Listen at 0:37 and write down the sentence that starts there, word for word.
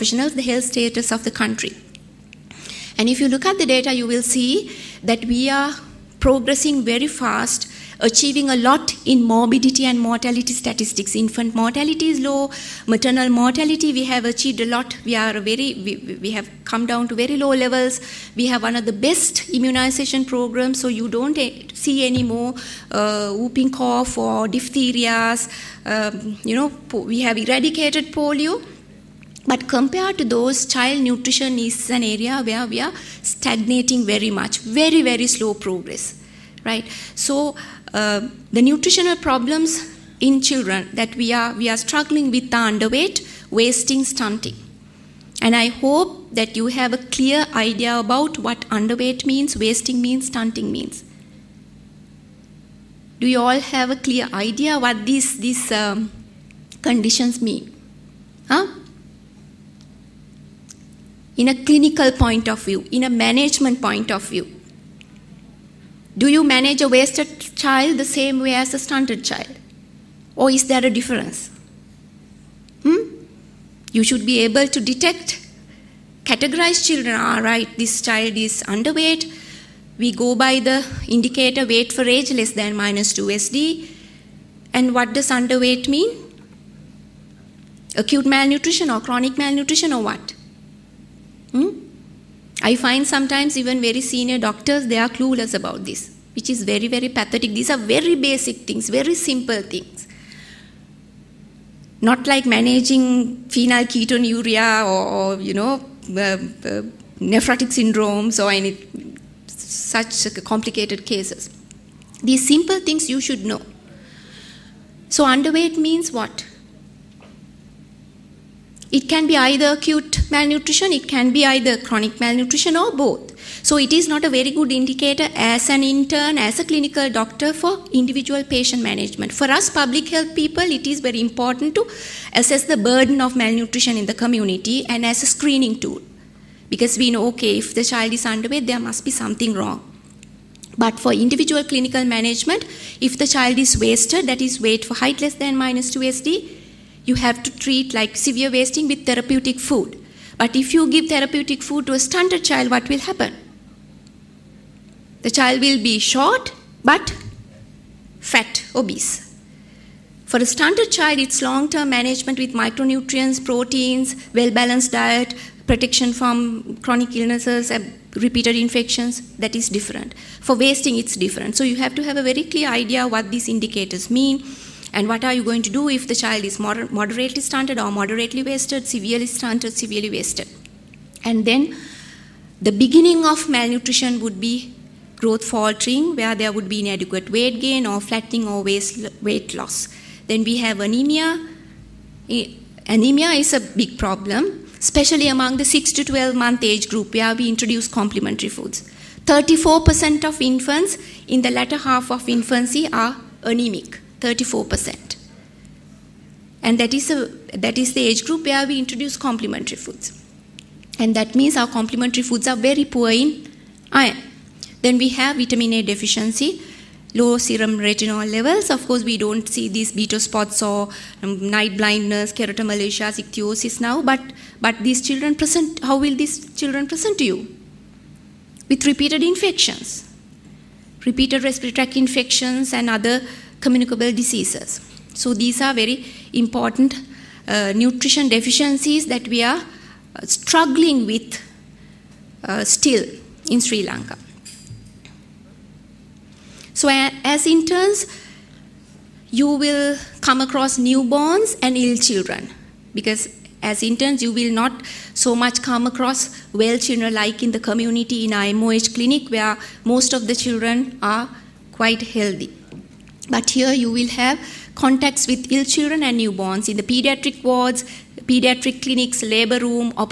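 So uh, the nutritional problems in children that we are, we are struggling with are underweight, wasting, stunting.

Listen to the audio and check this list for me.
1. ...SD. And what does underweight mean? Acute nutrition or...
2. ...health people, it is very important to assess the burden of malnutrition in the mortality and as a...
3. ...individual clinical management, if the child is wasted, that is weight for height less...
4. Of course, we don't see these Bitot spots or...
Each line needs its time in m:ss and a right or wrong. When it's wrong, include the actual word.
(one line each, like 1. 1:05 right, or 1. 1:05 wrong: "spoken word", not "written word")
1. 1:23 wrong: "malnutrition", not "nutrition"
2. 2:10 wrong: "community", not "mortality"
3. 2:21 right
4. 3:38 right.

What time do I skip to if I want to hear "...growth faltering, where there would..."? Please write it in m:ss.
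3:05.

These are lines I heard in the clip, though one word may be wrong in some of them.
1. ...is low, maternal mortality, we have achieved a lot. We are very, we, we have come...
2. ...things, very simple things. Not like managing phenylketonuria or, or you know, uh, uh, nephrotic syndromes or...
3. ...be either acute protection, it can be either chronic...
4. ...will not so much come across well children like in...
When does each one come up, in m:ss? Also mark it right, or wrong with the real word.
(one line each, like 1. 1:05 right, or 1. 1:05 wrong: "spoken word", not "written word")
1. 0:12 right
2. 1:38 right
3. 1:59 wrong: "malnutrition", not "protection"
4. 4:14 right.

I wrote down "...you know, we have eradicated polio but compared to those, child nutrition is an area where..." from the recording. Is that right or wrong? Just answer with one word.
right.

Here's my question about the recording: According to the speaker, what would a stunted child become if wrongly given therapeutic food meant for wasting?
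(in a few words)
short but fat.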